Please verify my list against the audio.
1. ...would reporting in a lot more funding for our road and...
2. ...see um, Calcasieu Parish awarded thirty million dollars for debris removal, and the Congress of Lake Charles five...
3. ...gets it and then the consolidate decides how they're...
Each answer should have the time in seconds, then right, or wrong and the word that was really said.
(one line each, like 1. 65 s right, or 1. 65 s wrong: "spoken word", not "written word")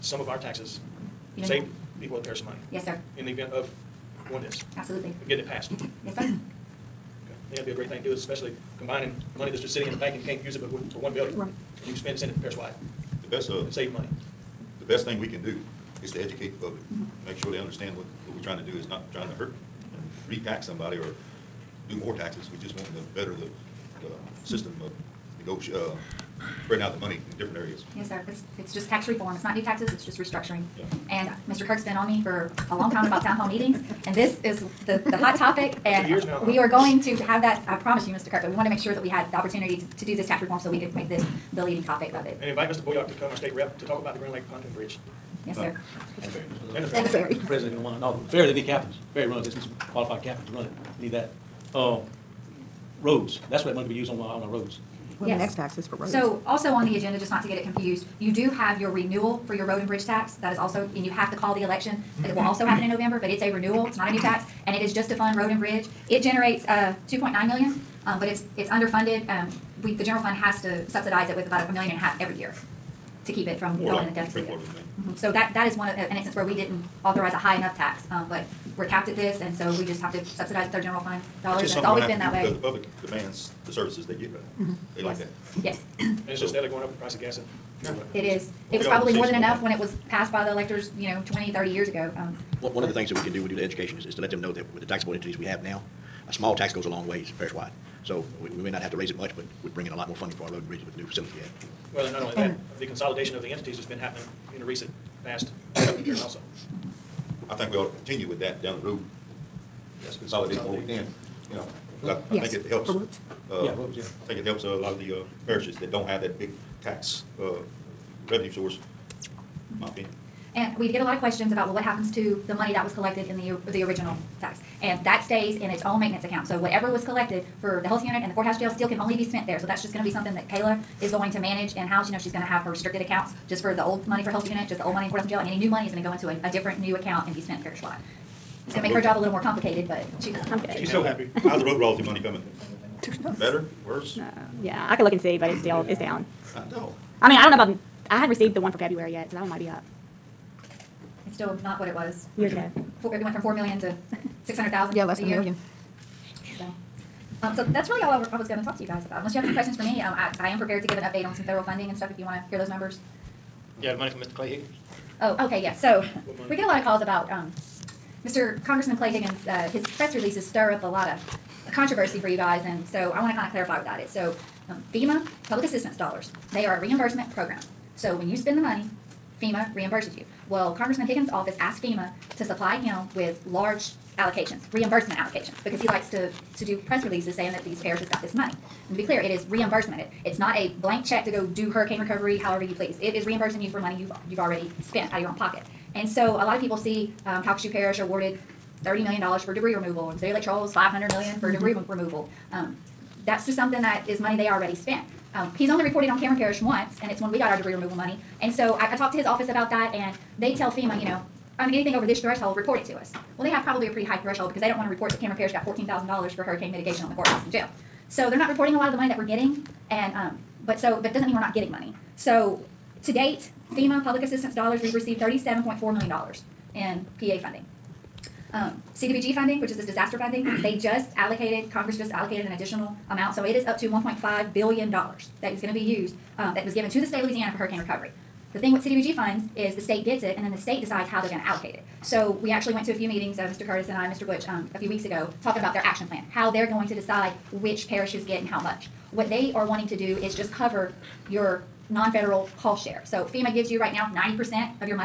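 1. 99 s wrong: "bring", not "reporting"
2. 196 s wrong: "City", not "Congress"
3. 240 s wrong: "state", not "consolidate".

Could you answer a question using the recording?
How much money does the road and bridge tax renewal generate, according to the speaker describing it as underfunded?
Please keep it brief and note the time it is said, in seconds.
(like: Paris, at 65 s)
2.9 million, at 67 s.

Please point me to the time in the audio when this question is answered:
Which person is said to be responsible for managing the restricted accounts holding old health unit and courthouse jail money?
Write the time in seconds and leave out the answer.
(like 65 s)
130 s.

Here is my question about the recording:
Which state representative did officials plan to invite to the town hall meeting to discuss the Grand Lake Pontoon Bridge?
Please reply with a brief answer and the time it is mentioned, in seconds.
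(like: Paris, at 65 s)
Mr. Bourriaque, at 42 s.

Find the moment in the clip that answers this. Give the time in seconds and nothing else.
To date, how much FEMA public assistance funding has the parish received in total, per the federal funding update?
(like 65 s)
225 s.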